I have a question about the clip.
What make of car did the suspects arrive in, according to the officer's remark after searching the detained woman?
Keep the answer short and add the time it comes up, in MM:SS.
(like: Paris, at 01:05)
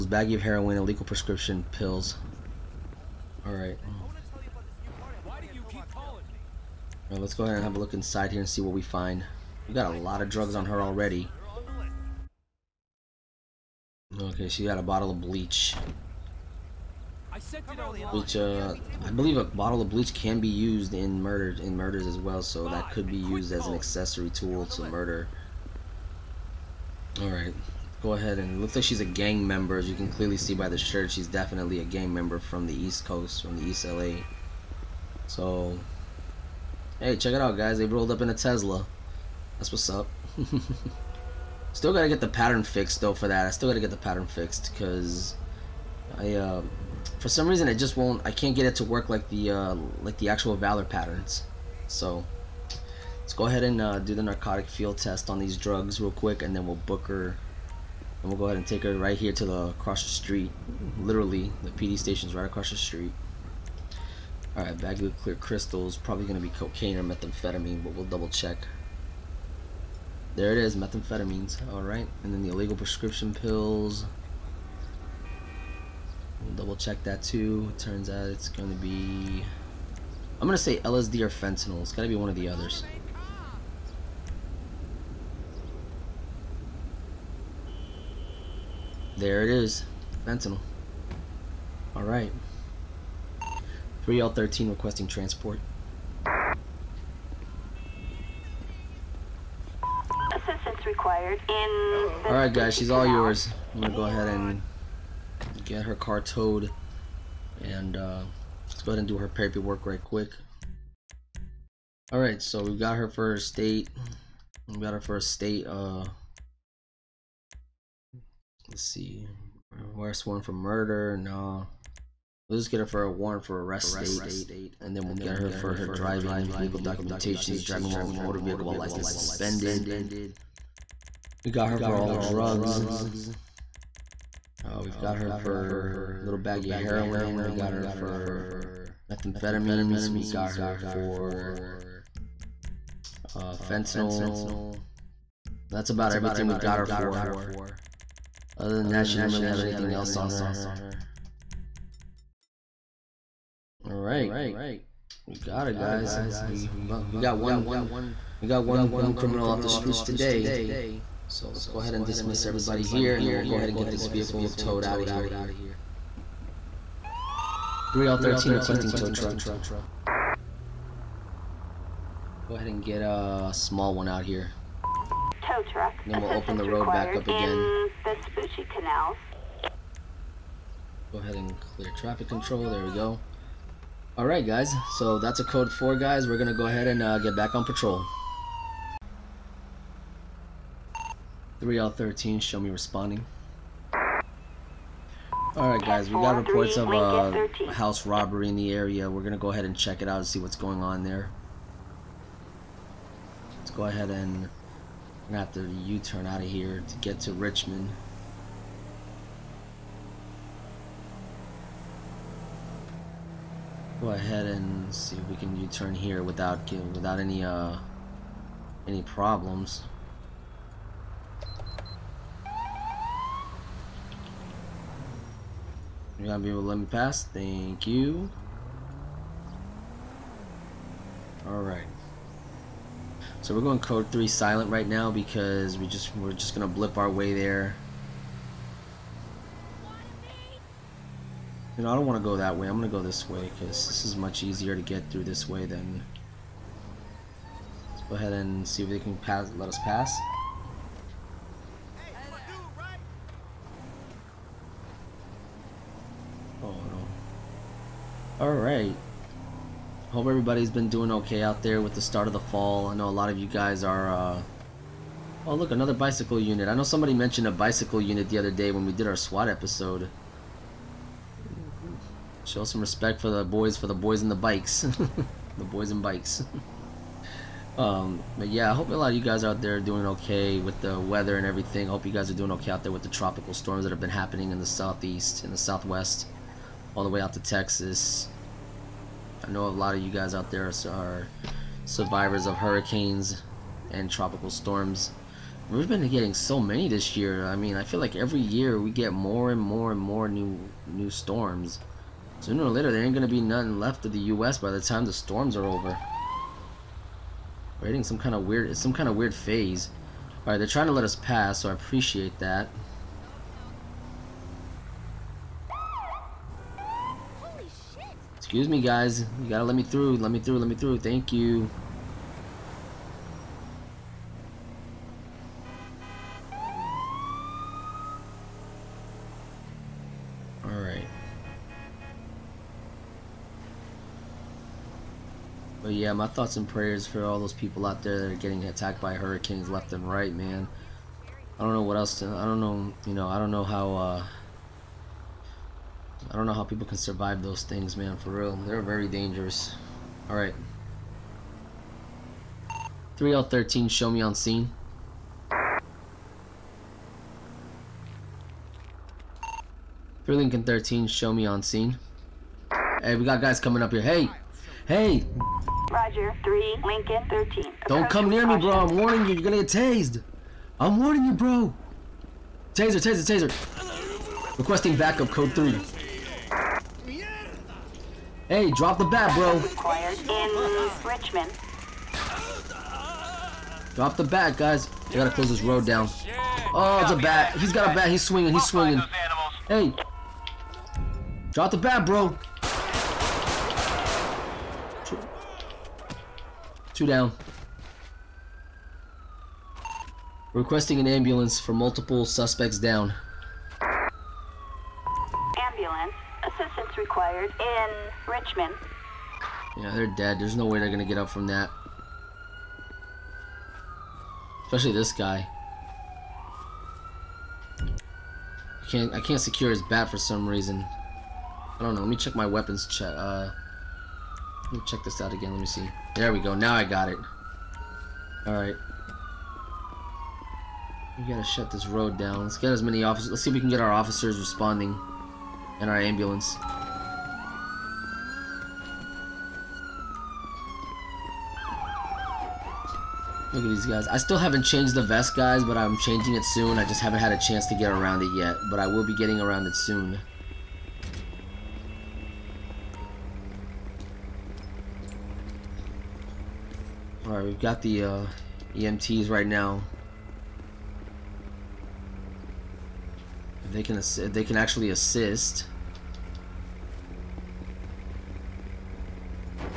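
Tesla, at 00:38.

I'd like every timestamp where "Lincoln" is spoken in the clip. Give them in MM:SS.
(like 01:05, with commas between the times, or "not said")
06:00, 06:06.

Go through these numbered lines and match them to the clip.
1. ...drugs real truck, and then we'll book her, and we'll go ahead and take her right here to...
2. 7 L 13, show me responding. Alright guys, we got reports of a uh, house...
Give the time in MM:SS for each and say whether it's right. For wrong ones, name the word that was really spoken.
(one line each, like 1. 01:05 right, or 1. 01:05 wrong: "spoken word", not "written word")
1. 00:55 wrong: "quick", not "truck"
2. 03:11 wrong: "3", not "7".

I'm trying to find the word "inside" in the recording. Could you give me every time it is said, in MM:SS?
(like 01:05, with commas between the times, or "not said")
00:07.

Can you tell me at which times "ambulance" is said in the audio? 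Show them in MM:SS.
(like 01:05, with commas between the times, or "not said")
06:41, 06:45, 07:15.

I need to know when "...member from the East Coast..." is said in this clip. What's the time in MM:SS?
00:32.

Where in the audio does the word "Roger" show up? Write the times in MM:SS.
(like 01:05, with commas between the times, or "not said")
06:05.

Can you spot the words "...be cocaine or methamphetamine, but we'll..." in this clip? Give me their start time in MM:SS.
01:06.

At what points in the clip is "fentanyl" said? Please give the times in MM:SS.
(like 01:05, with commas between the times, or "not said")
01:21, 01:30, 02:23.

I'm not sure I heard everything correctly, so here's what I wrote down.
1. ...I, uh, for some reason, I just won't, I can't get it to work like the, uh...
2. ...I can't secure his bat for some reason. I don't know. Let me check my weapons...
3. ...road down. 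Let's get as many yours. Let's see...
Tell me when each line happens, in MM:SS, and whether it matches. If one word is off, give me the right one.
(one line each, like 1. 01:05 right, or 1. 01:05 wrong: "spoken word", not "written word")
1. 00:46 right
2. 06:59 right
3. 07:11 wrong: "officers", not "yours".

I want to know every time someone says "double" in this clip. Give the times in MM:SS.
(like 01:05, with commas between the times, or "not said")
01:08, 01:16.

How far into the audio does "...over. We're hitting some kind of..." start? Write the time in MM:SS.
05:05.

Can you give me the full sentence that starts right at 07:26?
I just haven't had a chance to get around it yet.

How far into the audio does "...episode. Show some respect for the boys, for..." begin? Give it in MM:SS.
04:29.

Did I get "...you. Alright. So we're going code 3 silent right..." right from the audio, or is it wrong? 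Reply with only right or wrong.
right.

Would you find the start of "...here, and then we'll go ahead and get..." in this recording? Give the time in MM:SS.
02:42.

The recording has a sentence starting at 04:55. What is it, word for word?
We've been getting so many this year.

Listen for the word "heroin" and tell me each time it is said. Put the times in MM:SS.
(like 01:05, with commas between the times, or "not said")
00:00, 02:16.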